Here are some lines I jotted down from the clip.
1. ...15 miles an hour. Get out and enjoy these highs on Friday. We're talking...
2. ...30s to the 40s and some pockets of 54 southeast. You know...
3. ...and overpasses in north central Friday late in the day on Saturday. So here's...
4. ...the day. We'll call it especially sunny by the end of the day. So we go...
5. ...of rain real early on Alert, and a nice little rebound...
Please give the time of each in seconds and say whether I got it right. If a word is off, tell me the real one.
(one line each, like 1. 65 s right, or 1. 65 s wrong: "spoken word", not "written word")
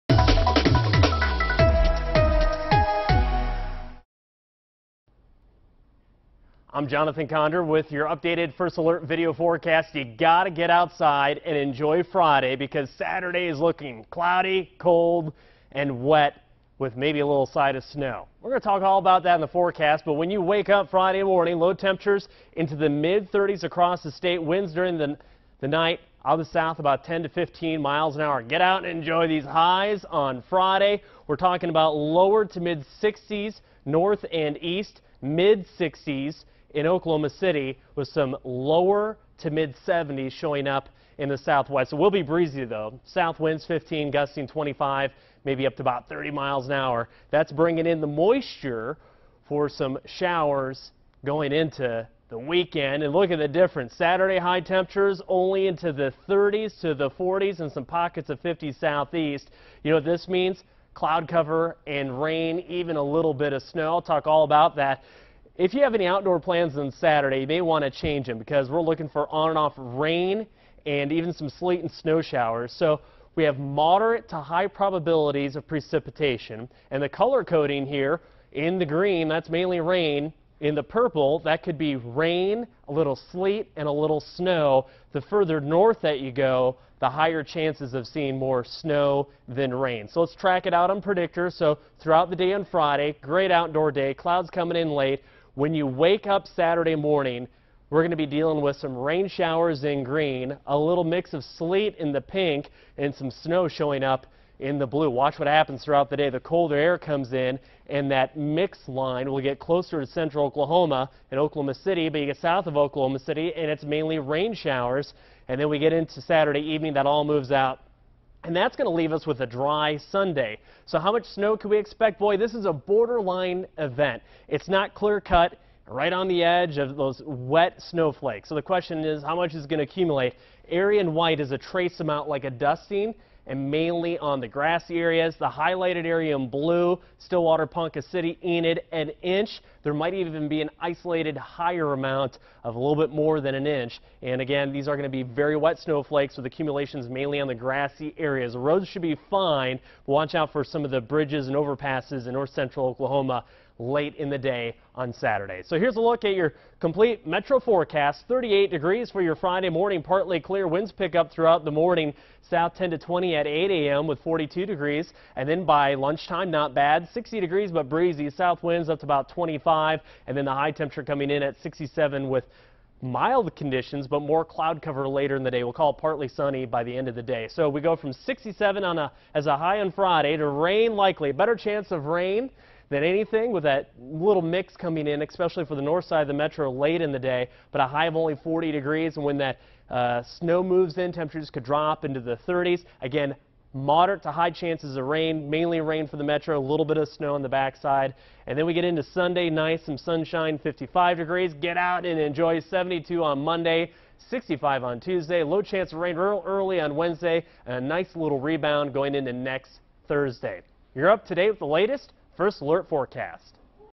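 1. 27 s right
2. 56 s wrong: "50", not "54"
3. 151 s wrong: "Oklahoma", not "Friday"
4. 175 s wrong: "partly", not "especially"
5. 205 s wrong: "Wednesday", not "Alert".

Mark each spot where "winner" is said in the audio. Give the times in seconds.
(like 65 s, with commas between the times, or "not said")
not said.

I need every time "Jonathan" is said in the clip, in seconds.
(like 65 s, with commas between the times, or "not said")
6 s.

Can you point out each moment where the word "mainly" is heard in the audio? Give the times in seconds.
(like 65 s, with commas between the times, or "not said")
79 s, 113 s, 133 s, 147 s, 195 s.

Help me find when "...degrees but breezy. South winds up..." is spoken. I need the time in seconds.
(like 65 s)
167 s.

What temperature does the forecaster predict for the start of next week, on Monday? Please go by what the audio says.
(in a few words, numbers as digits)
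72.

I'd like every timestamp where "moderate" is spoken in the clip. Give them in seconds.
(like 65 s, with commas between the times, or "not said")
73 s, 193 s.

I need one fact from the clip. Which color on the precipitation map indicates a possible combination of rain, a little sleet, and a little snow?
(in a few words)
purple.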